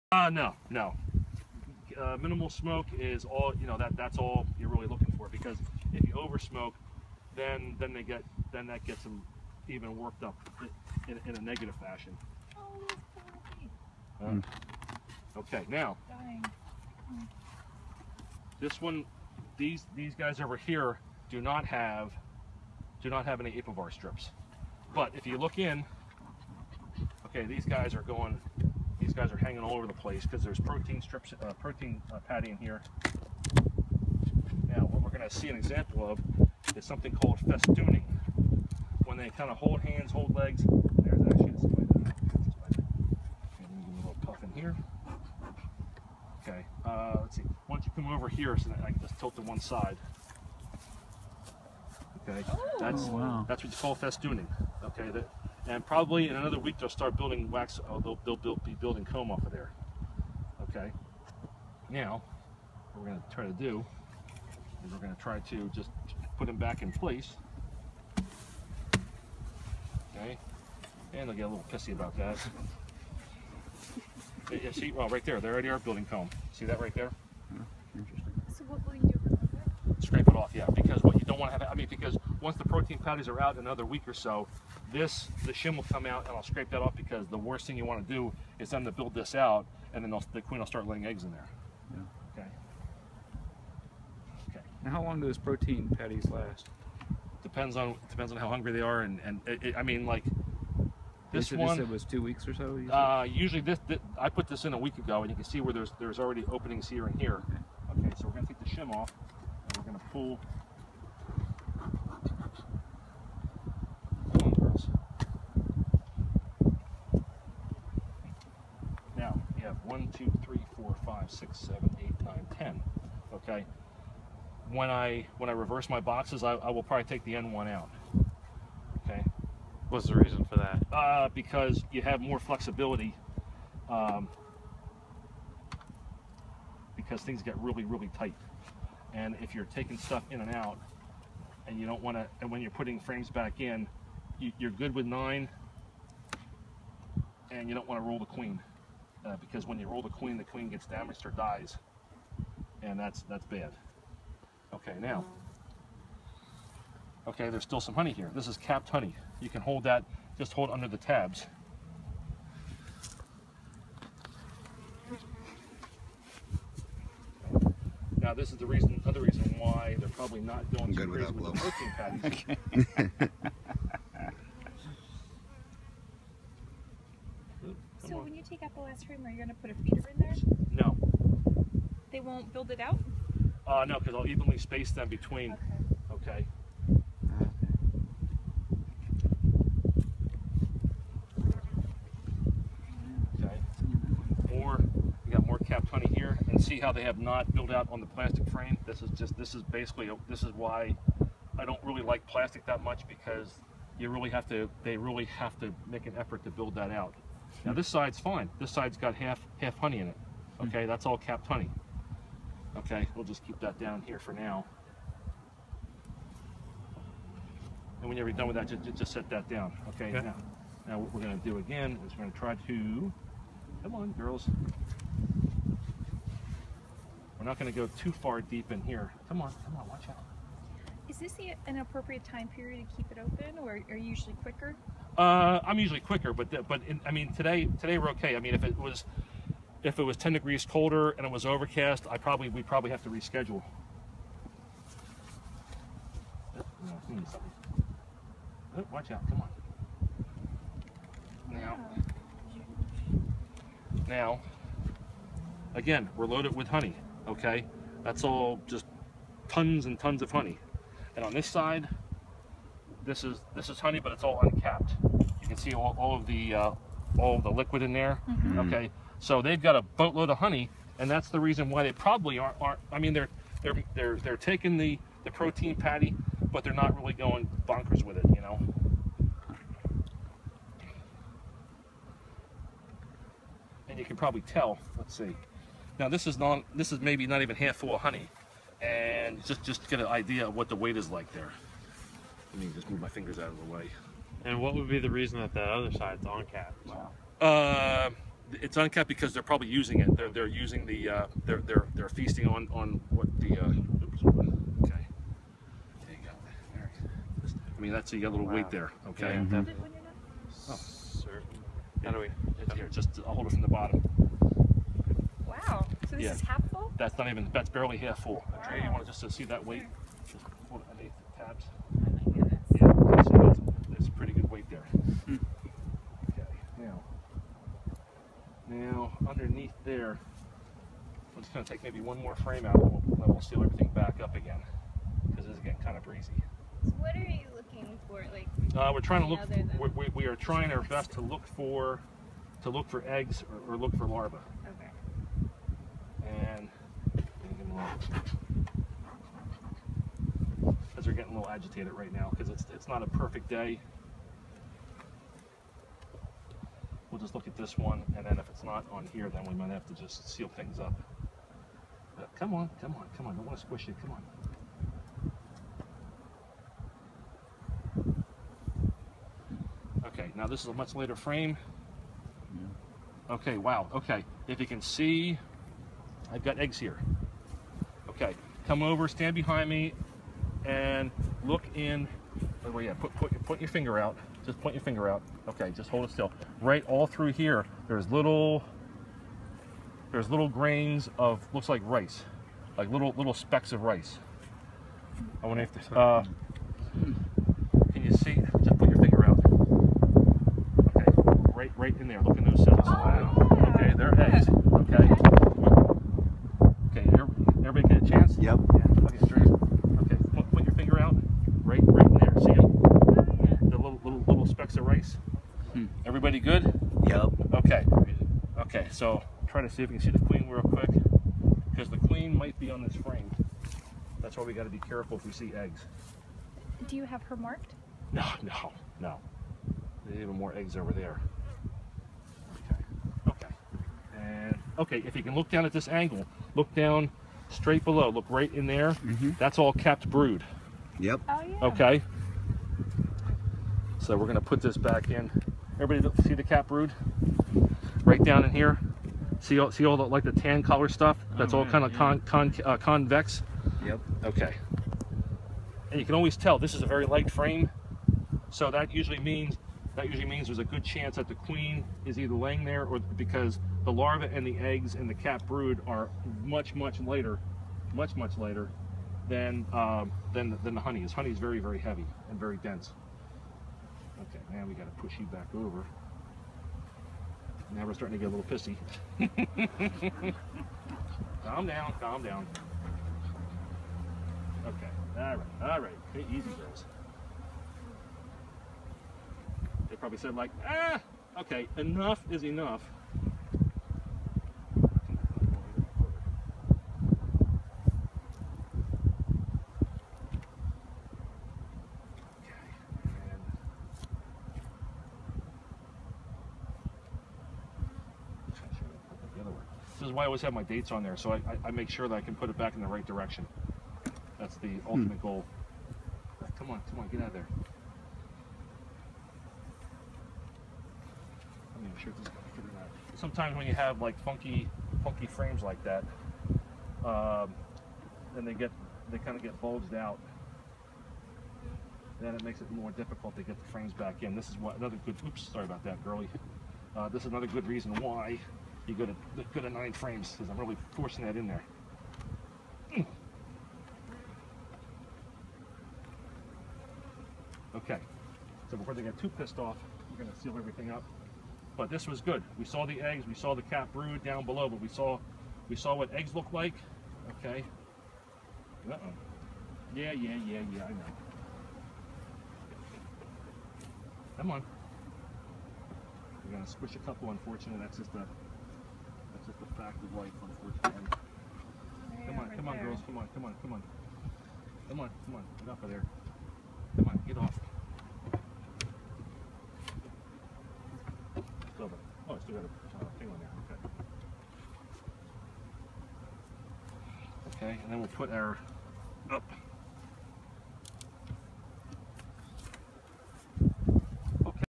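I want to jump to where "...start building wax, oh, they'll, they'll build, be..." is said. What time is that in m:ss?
0:56.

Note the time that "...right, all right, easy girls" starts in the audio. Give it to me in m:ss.
8:05.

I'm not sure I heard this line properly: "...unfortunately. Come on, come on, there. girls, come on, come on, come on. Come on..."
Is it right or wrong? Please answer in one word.
right.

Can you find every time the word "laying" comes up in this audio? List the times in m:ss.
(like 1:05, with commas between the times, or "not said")
1:30, 7:42.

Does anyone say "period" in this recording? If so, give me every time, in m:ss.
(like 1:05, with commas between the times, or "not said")
3:52.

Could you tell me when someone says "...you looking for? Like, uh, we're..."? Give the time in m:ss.
5:37.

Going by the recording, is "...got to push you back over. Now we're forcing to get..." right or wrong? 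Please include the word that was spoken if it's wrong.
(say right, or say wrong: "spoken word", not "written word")
wrong: "starting", not "forcing".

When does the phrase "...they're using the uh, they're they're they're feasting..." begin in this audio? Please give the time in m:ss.
5:00.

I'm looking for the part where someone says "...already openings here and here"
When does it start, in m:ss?
1:46.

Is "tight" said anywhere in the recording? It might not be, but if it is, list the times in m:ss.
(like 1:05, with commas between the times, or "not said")
2:18.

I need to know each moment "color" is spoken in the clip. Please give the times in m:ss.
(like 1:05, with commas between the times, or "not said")
7:30.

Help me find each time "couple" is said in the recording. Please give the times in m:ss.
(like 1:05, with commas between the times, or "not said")
9:26.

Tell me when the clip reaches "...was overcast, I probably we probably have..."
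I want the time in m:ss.
4:01.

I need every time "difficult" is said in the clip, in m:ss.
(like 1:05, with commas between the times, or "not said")
8:52.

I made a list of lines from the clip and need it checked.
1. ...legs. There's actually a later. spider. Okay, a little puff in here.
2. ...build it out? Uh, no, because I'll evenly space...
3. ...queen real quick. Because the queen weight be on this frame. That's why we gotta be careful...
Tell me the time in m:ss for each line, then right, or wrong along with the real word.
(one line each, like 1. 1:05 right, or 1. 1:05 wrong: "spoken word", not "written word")
1. 0:40 wrong: "spider", not "later"
2. 3:02 right
3. 7:00 wrong: "might", not "weight".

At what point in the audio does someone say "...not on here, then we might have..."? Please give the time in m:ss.
5:58.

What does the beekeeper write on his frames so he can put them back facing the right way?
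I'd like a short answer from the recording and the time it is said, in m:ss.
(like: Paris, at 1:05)
dates, at 8:30.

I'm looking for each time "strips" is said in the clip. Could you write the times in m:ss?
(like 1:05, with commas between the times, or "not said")
0:23, 0:31.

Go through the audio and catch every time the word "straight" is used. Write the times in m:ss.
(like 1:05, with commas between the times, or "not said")
7:17.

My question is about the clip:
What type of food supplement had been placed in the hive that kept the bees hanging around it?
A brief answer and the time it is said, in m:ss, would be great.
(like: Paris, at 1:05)
protein patty, at 0:31.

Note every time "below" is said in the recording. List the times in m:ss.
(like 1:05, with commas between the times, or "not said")
7:17, 9:14.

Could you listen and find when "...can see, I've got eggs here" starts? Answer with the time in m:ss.
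6:14.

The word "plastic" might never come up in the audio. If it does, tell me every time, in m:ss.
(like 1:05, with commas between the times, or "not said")
3:18, 3:22.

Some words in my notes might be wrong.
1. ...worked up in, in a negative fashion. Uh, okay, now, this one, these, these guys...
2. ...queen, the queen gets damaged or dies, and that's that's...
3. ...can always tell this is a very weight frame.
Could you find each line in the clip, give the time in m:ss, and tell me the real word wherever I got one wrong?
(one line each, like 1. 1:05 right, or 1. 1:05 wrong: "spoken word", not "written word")
1. 0:09 right
2. 2:30 right
3. 7:36 wrong: "light", not "weight".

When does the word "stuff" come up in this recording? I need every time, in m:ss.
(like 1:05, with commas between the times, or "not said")
2:19, 7:30.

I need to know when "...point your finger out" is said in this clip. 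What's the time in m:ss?
6:24.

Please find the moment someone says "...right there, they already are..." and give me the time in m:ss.
1:15.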